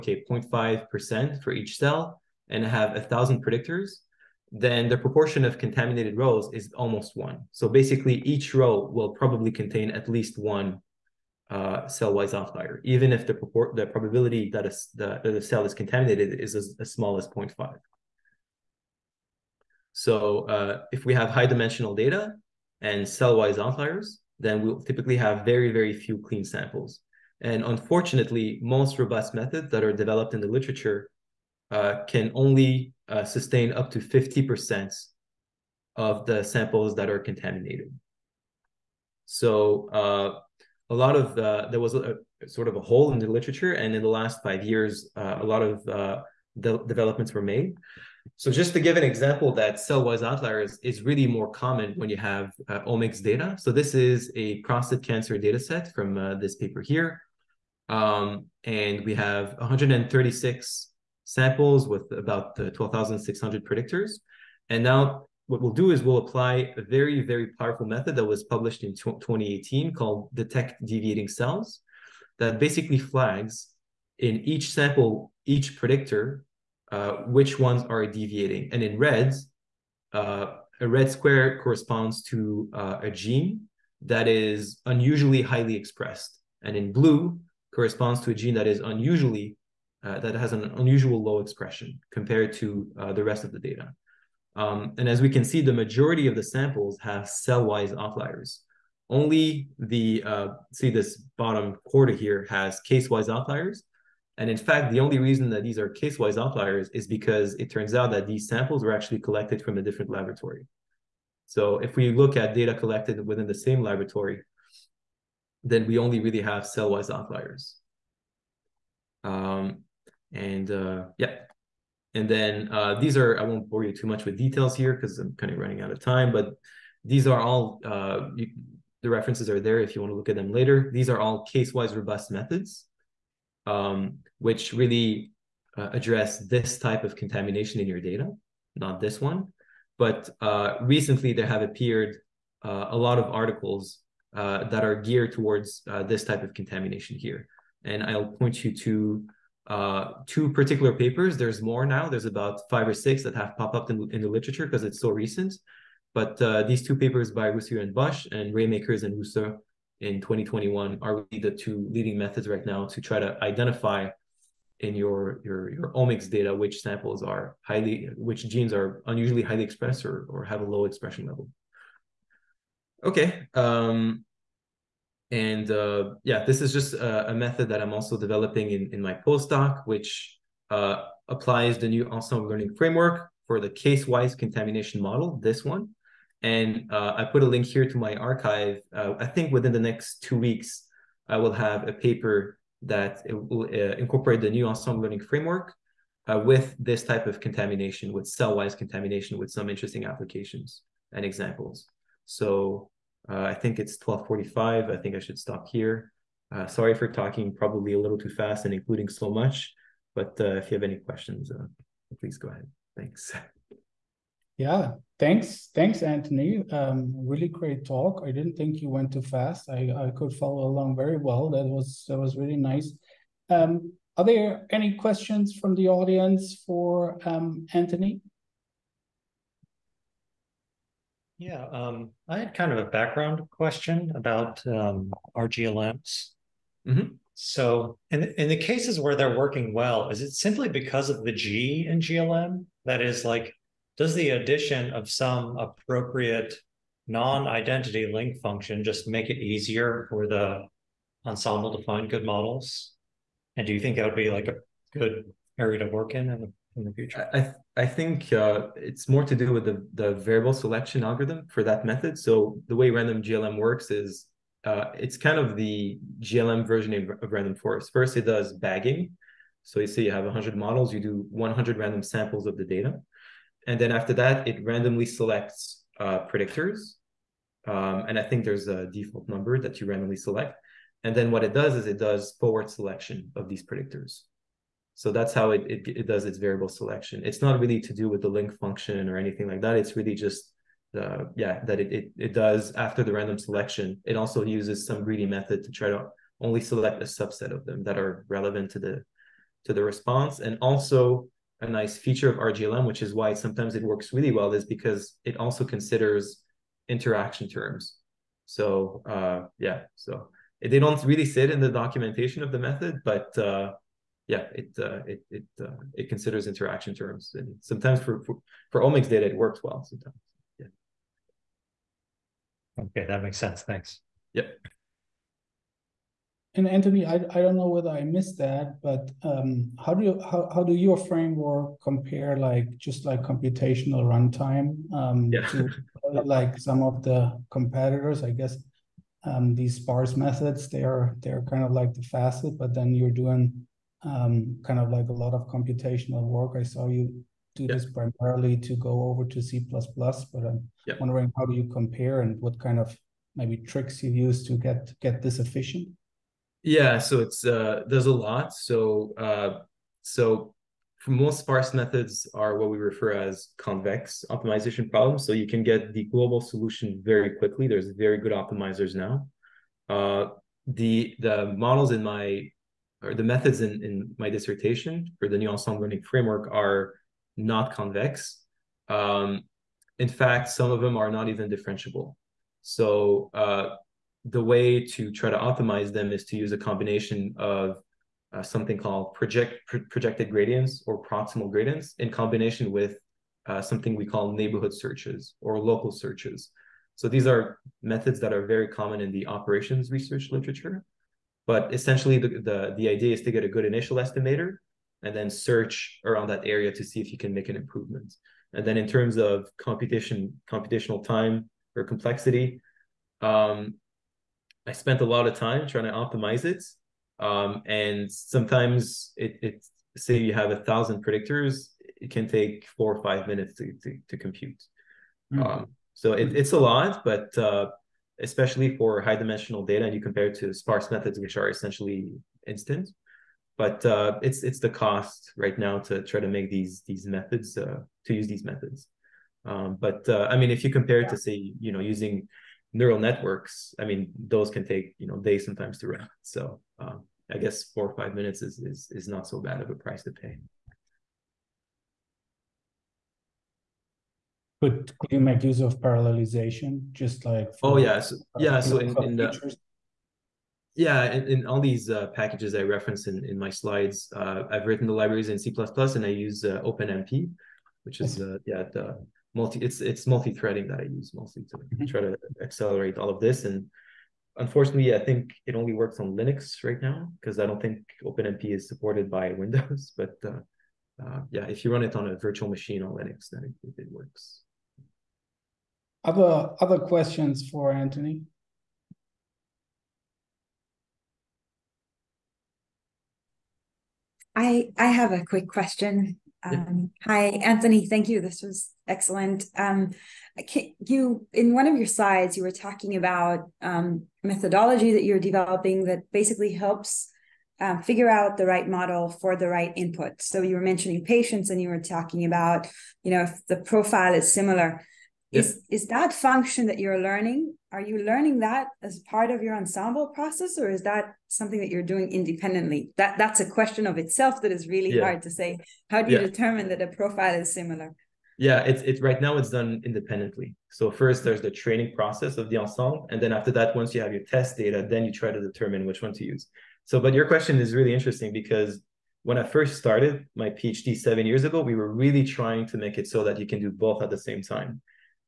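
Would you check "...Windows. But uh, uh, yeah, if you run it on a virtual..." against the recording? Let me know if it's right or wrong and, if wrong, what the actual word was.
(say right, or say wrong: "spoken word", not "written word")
right.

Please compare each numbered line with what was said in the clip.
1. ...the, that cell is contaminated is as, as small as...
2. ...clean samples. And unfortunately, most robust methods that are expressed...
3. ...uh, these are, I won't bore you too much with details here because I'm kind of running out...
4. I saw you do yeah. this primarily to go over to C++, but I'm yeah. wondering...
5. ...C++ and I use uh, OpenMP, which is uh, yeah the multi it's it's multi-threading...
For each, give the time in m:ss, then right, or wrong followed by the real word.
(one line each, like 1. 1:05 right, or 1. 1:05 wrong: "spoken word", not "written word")
1. 0:14 right
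2. 0:26 wrong: "developed", not "expressed"
3. 2:02 right
4. 5:46 right
5. 7:45 right.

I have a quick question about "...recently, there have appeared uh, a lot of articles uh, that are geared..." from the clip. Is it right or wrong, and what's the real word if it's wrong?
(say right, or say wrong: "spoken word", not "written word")
right.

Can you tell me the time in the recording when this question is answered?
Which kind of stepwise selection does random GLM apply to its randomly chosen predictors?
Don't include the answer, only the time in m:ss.
4:42.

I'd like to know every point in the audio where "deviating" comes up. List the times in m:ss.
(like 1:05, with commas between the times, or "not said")
1:10, 1:18.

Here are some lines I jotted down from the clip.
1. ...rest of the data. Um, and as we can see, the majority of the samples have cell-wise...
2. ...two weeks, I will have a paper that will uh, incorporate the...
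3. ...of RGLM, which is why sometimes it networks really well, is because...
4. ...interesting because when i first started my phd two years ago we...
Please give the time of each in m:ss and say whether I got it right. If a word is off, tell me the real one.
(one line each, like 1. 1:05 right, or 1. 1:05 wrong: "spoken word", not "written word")
1. 1:33 right
2. 3:10 right
3. 5:02 wrong: "works", not "networks"
4. 8:57 wrong: "seven", not "two".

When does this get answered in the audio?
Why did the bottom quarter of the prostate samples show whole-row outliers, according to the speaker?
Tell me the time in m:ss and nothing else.
1:49.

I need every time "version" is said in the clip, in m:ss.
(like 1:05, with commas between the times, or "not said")
4:26.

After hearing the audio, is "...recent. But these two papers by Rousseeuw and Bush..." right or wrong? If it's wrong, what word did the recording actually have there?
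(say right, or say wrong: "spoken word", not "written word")
right.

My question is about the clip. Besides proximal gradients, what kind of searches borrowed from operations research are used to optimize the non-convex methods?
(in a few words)
neighborhood searches.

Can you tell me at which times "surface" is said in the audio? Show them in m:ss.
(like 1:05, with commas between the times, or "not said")
not said.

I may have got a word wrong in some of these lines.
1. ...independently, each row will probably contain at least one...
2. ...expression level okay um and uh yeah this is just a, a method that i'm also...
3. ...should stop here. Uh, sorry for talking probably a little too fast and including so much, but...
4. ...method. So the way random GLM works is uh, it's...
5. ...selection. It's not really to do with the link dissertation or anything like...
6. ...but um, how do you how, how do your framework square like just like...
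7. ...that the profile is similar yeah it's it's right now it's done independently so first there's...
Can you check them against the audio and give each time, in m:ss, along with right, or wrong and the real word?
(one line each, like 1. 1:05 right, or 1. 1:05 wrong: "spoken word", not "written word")
1. 0:07 wrong: "basically", not "independently"
2. 2:50 right
3. 3:25 right
4. 4:21 right
5. 4:46 wrong: "function", not "dissertation"
6. 5:28 wrong: "compare", not "square"
7. 8:46 right.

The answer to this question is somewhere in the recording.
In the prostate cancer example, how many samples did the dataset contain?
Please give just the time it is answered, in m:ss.
0:59.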